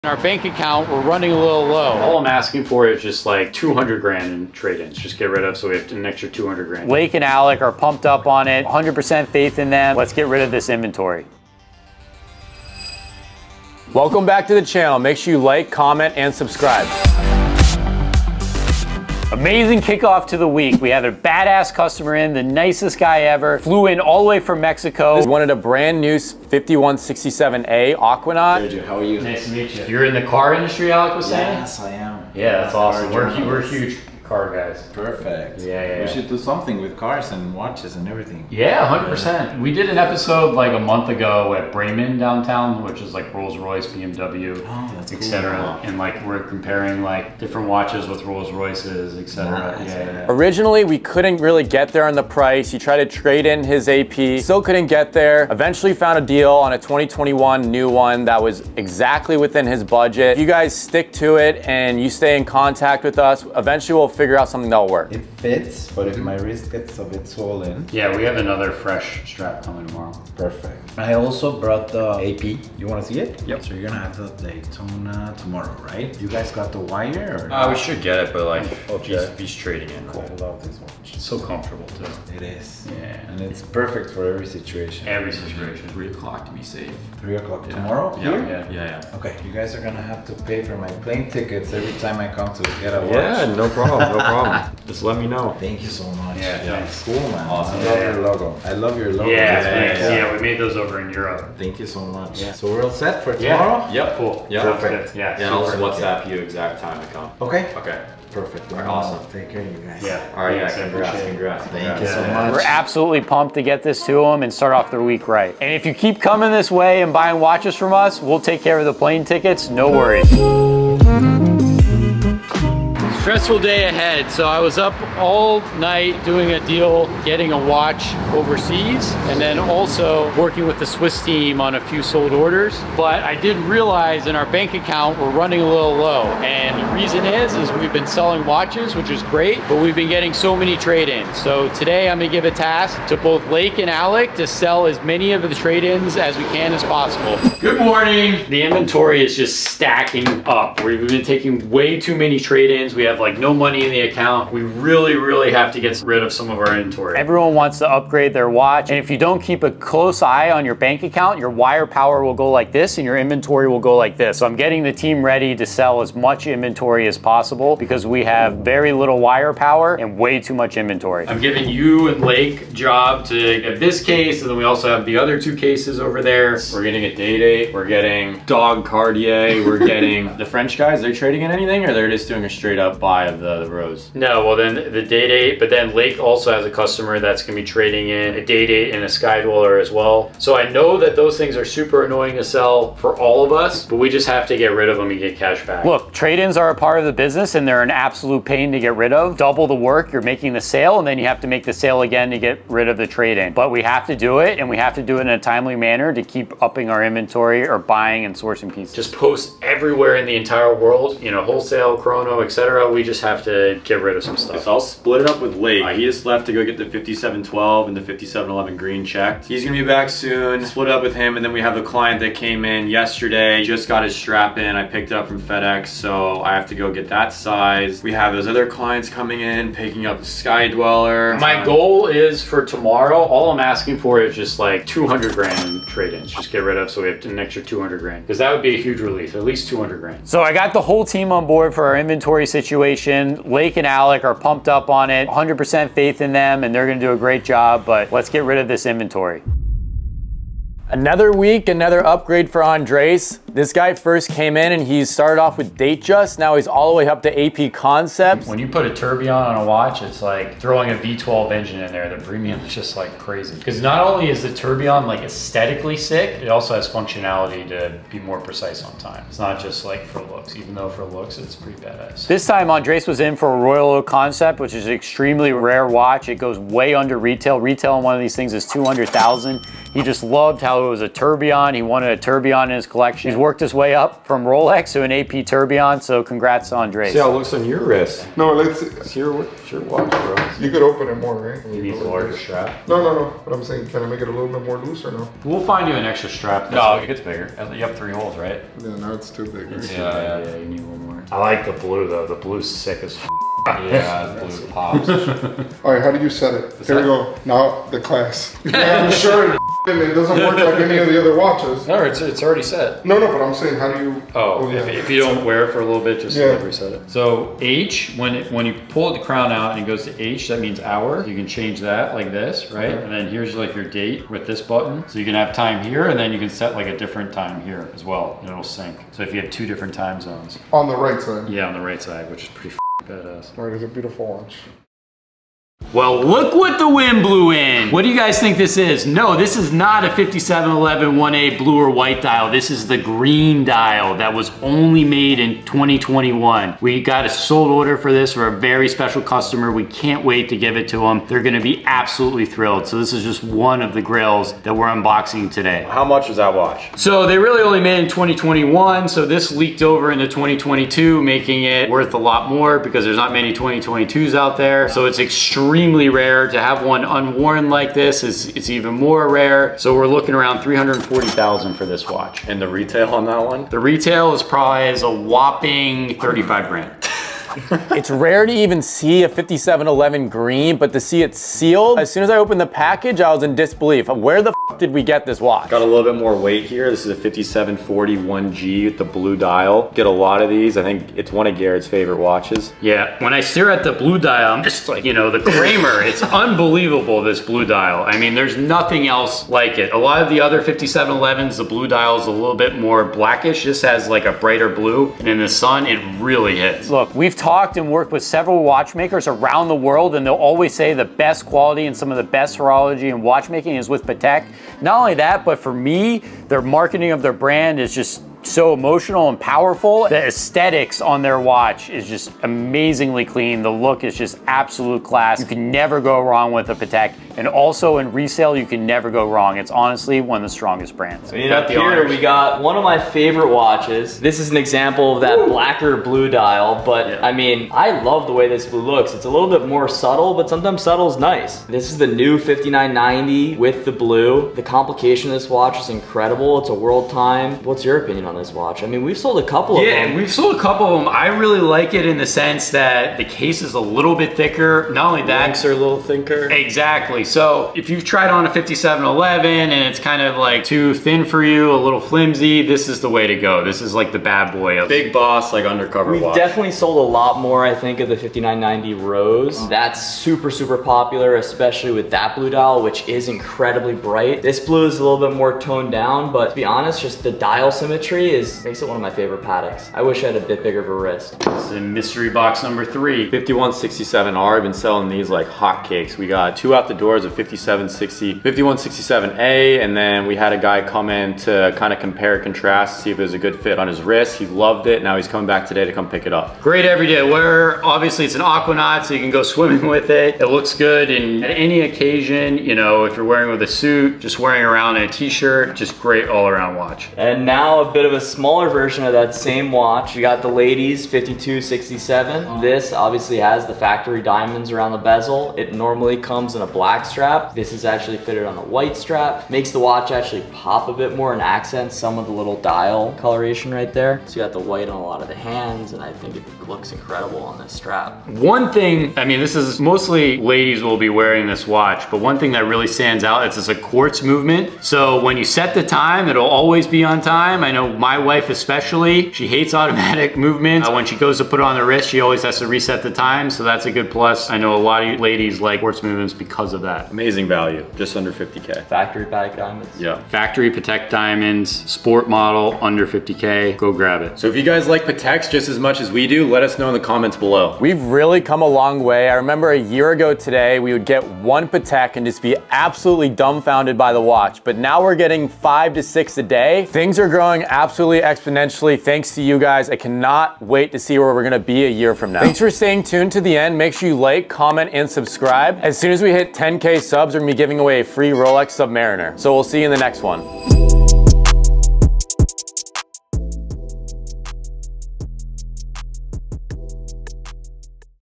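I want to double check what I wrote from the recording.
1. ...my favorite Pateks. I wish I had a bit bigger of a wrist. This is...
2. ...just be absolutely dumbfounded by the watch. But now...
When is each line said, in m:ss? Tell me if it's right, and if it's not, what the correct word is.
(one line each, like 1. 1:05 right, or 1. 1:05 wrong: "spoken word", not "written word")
1. 7:59 right
2. 9:22 right.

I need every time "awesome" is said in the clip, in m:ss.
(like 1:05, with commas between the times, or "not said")
0:32, 1:37, 1:48.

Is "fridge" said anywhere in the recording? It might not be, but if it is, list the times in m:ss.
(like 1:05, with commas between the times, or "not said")
not said.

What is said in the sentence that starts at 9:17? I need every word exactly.
We've really come a long way.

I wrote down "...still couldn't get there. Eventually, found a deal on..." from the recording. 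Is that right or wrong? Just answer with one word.
right.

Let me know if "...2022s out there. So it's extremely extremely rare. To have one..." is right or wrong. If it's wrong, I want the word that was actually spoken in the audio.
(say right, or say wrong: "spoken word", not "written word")
right.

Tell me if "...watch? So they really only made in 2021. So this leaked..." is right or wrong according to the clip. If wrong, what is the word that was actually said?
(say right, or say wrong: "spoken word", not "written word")
right.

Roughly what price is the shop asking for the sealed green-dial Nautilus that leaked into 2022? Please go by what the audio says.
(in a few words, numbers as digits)
340,000.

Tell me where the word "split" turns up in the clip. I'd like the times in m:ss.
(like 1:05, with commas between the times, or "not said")
3:34, 3:40.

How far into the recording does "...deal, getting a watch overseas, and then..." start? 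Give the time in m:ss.
2:06.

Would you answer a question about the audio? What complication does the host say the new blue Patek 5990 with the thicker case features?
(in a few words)
World time.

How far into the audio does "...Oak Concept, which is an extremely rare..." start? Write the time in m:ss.
4:33.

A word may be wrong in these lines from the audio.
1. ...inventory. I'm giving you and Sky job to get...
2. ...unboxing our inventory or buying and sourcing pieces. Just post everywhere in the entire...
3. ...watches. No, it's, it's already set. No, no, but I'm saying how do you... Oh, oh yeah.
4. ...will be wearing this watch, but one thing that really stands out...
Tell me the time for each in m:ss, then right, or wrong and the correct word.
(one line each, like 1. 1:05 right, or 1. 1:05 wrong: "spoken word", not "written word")
1. 2:50 wrong: "Lake", not "Sky"
2. 3:26 wrong: "upping", not "unboxing"
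3. 5:11 right
4. 8:50 right.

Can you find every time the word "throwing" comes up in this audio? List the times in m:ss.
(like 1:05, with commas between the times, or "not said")
4:20.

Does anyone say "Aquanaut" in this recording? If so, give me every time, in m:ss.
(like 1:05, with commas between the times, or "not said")
0:27, 8:18.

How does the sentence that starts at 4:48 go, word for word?
It's your, it's your watch, bro.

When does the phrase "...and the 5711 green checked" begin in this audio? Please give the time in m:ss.
3:37.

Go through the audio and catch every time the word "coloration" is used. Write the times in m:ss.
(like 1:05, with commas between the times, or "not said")
8:43.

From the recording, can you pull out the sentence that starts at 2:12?
But I did realize in our bank account, we're running a little low.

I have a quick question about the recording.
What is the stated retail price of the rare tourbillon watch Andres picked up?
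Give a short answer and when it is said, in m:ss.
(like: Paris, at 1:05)
200,000, at 4:38.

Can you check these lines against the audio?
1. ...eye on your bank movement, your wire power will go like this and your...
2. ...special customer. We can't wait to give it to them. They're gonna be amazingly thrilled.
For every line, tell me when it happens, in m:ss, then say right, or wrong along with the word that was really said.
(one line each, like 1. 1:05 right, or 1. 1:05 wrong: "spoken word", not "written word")
1. 2:40 wrong: "account", not "movement"
2. 5:48 wrong: "absolutely", not "amazingly".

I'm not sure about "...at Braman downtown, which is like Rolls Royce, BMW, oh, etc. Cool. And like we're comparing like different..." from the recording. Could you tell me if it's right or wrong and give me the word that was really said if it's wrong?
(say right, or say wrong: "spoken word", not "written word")
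right.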